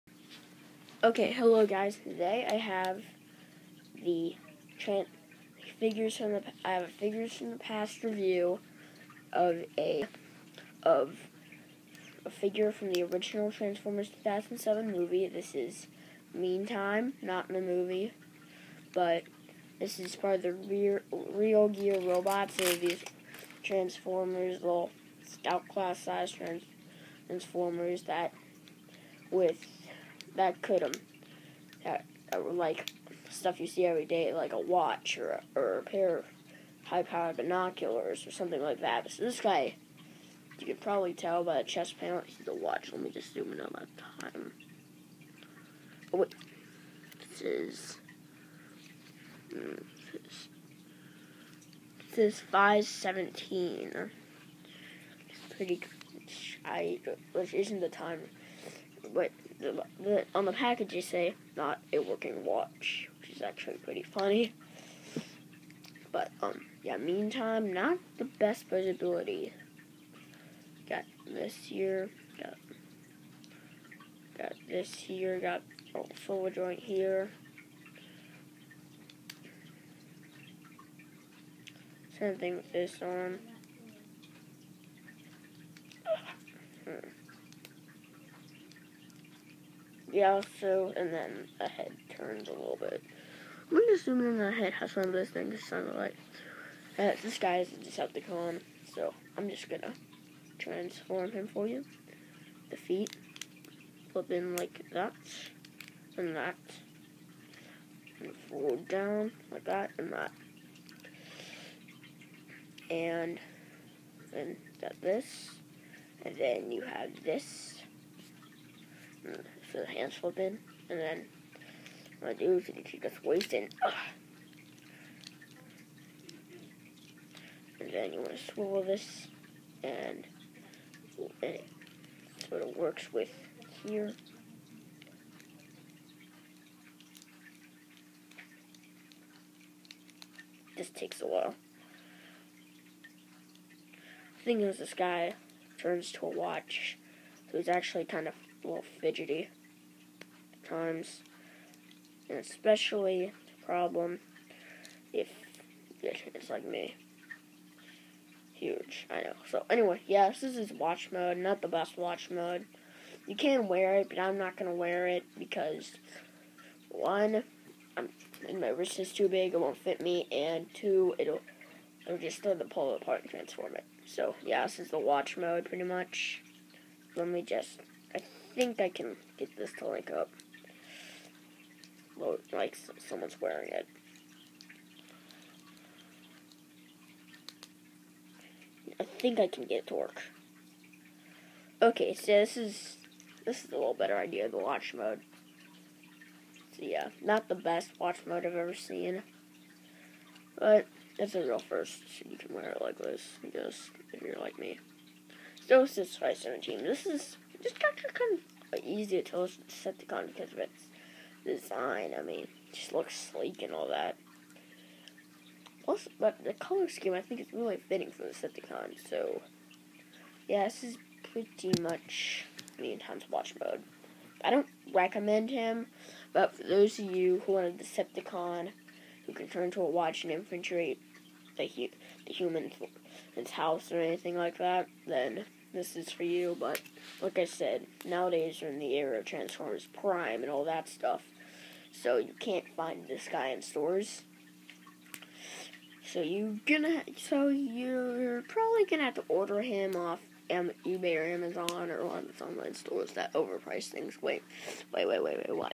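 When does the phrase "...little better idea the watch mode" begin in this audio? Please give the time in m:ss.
3:13.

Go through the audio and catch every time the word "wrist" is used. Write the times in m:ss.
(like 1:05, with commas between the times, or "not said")
2:48.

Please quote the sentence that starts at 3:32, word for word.
I mean, just looks sleek and all that.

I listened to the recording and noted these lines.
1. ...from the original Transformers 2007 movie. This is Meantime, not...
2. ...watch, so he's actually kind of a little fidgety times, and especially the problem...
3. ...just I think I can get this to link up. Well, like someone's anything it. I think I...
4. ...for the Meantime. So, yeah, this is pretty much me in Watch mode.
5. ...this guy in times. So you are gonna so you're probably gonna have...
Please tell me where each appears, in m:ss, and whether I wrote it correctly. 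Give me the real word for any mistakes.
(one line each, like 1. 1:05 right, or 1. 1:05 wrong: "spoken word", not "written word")
1. 0:12 right
2. 2:26 right
3. 2:57 wrong: "wearing", not "anything"
4. 3:38 wrong: "Decepticon", not "Meantime"
5. 4:03 wrong: "stores", not "times".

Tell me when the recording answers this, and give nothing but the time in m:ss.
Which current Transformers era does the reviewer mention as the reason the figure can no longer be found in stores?
3:59.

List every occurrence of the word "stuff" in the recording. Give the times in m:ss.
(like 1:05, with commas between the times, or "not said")
0:33, 4:00.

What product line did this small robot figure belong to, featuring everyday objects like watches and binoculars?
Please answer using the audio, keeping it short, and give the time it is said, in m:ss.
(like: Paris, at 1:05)
Real Gear Robots, at 0:21.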